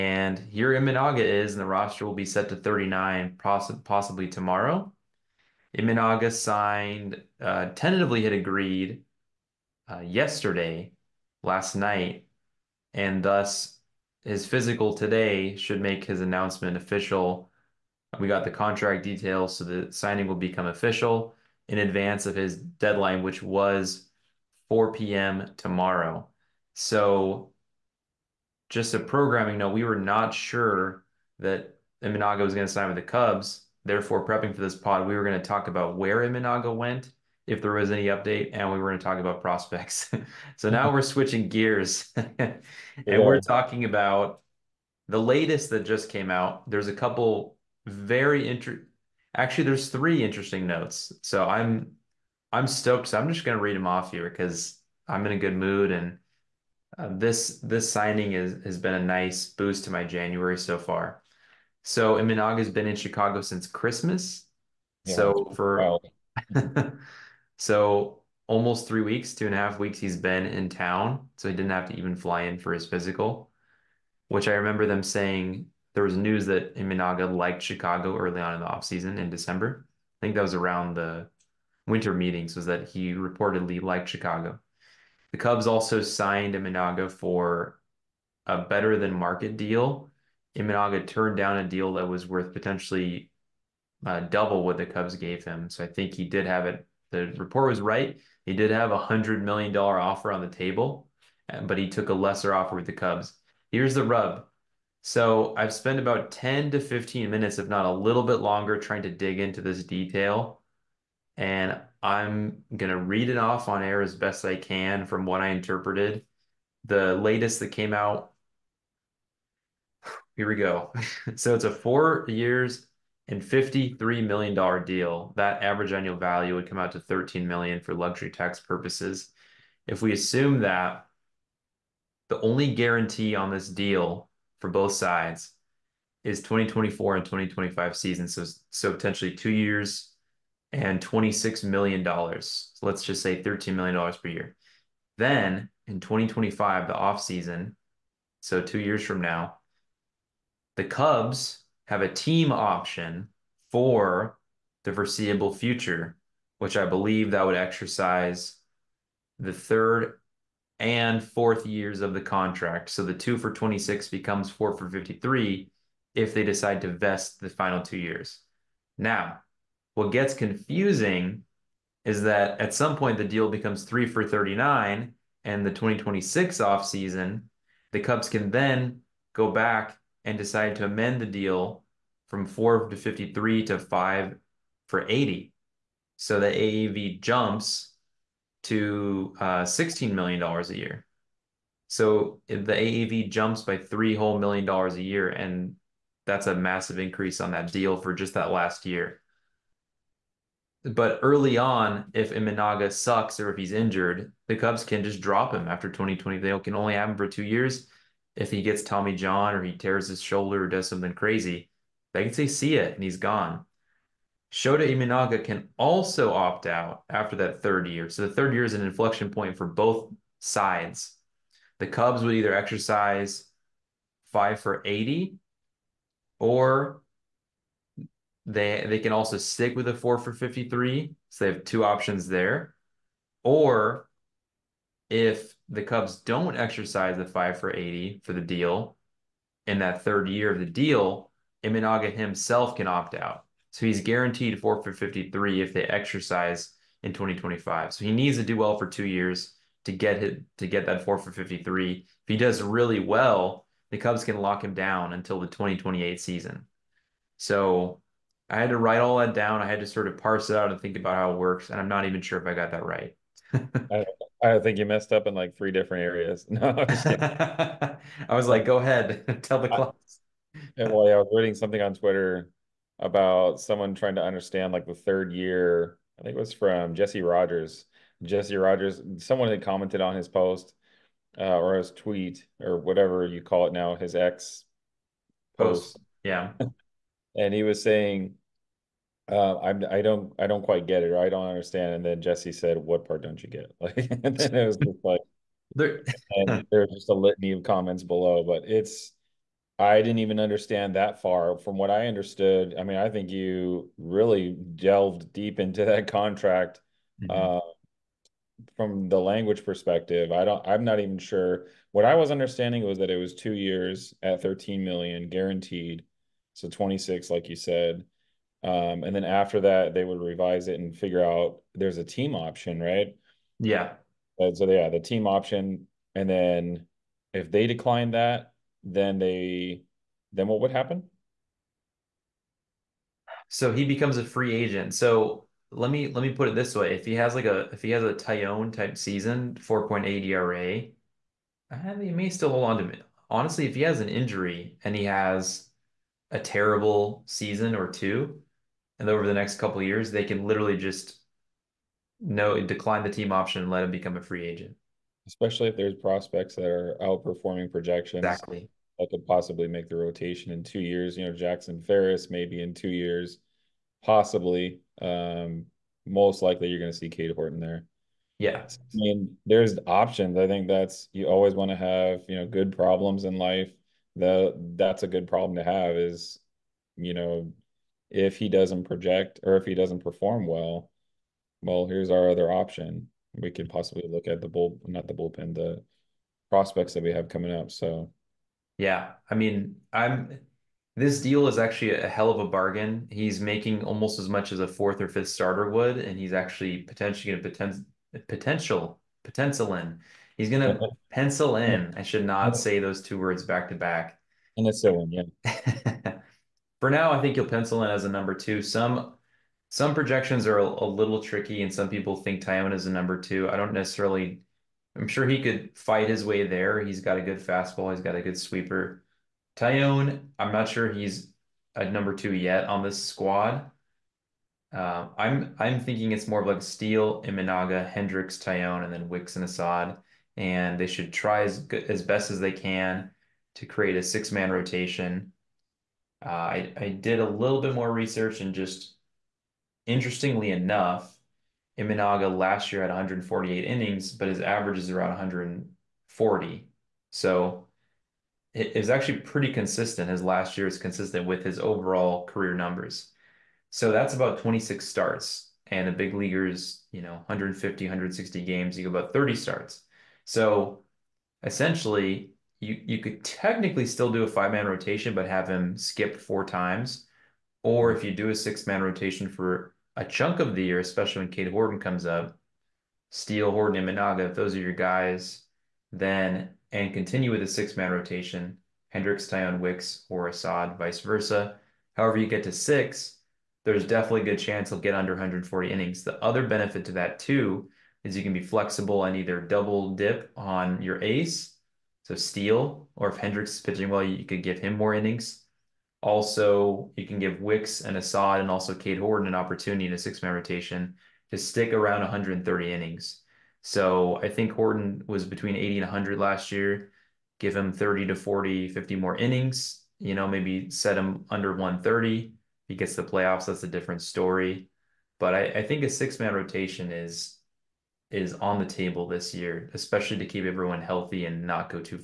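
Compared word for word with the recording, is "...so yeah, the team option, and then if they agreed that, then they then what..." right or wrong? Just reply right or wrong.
wrong.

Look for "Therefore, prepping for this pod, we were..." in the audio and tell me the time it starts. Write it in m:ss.
0:33.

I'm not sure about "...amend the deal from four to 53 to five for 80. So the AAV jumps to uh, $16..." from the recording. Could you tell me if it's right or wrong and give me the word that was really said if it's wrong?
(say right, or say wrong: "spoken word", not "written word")
right.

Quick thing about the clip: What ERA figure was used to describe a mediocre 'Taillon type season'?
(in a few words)
4.8.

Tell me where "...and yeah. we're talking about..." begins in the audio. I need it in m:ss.
0:42.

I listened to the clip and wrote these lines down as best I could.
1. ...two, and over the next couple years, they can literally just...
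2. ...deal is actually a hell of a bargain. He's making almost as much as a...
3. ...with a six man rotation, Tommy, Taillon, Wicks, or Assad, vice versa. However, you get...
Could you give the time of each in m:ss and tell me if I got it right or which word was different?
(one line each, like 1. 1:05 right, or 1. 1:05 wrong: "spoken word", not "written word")
1. 5:47 right
2. 6:31 right
3. 7:57 wrong: "Hendricks", not "Tommy".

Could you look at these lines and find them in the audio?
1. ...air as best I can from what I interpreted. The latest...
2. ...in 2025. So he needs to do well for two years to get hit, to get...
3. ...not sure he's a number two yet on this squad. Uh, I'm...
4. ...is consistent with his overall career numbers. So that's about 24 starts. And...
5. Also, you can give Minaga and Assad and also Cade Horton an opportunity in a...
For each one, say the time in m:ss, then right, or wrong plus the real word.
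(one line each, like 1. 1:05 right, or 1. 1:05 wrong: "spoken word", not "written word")
1. 1:53 right
2. 4:07 right
3. 7:00 right
4. 7:30 wrong: "26", not "24"
5. 8:16 wrong: "Wicks", not "Minaga".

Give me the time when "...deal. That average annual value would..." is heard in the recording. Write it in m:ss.
2:04.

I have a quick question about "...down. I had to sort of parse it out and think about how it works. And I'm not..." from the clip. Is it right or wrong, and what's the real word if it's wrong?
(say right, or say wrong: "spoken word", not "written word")
right.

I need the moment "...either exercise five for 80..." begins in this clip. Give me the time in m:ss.
3:42.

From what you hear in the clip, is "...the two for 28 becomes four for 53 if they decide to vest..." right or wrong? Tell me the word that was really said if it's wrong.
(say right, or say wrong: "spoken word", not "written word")
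wrong: "26", not "28".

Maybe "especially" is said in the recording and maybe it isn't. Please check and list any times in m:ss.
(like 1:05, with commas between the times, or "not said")
5:55, 7:50, 8:39.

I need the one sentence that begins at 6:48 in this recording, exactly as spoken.
Some some projections are a, a little tricky, and some people think Taillon is a number two.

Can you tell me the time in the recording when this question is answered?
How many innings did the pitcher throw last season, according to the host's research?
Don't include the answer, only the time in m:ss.
7:22.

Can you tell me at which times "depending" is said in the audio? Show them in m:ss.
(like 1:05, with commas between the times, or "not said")
not said.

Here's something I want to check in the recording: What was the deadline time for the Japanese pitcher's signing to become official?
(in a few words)
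4 p.m.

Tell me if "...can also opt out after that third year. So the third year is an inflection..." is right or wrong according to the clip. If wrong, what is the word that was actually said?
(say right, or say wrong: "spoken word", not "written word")
right.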